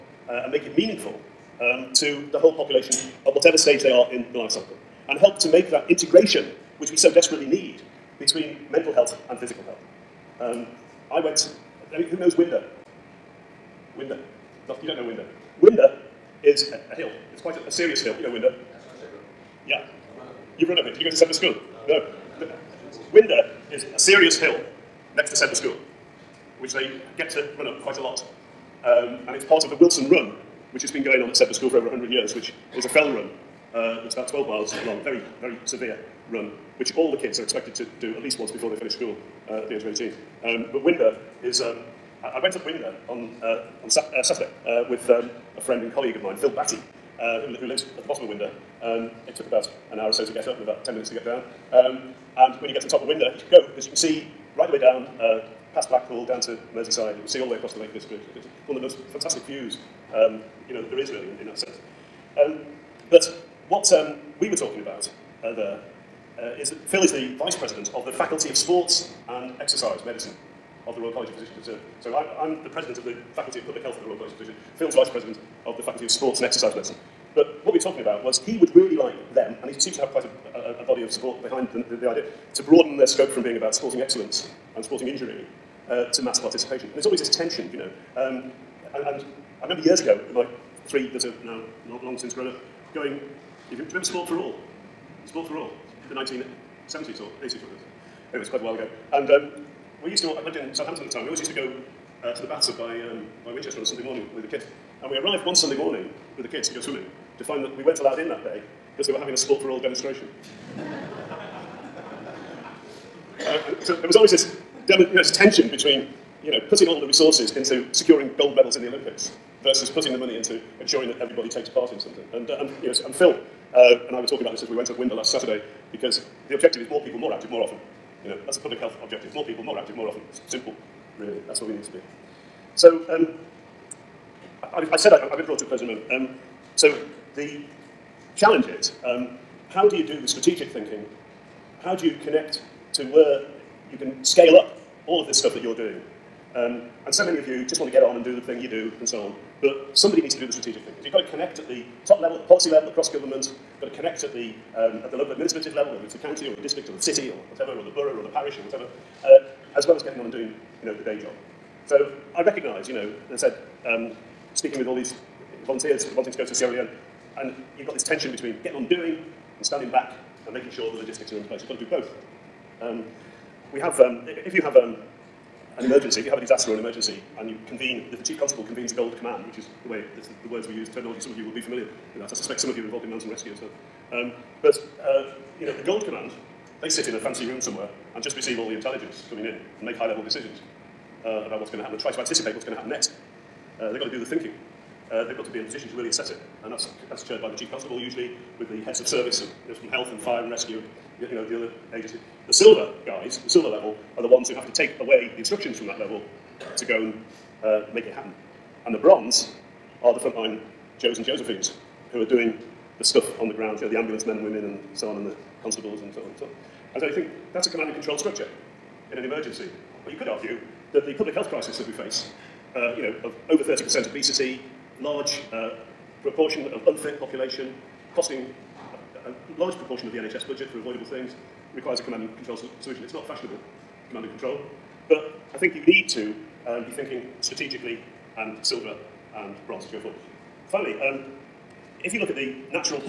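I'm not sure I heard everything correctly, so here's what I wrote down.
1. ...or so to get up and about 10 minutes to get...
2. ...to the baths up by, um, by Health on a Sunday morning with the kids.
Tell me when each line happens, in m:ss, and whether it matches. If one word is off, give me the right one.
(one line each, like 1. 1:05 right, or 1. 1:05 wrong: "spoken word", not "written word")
1. 0:50 right
2. 1:42 wrong: "Winchester", not "Health".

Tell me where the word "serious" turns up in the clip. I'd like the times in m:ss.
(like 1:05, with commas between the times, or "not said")
0:17, 0:23.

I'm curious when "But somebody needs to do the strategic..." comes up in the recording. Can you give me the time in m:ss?
2:29.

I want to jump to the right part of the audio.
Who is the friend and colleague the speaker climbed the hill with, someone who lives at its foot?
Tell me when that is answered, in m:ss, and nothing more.
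0:46.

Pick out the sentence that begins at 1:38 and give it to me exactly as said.
Anyway, it's quite a while ago.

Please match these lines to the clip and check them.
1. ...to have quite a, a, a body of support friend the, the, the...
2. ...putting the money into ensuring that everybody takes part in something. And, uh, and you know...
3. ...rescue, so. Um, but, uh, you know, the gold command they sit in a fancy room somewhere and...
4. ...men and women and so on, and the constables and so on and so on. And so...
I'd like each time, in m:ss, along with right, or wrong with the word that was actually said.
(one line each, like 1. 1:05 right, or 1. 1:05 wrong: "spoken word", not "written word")
1. 1:19 wrong: "behind", not "friend"
2. 1:59 right
3. 3:03 right
4. 3:34 right.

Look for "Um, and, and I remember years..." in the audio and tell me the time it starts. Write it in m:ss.
1:28.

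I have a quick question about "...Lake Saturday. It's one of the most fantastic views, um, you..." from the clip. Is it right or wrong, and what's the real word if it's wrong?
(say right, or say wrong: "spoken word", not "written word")
wrong: "District", not "Saturday".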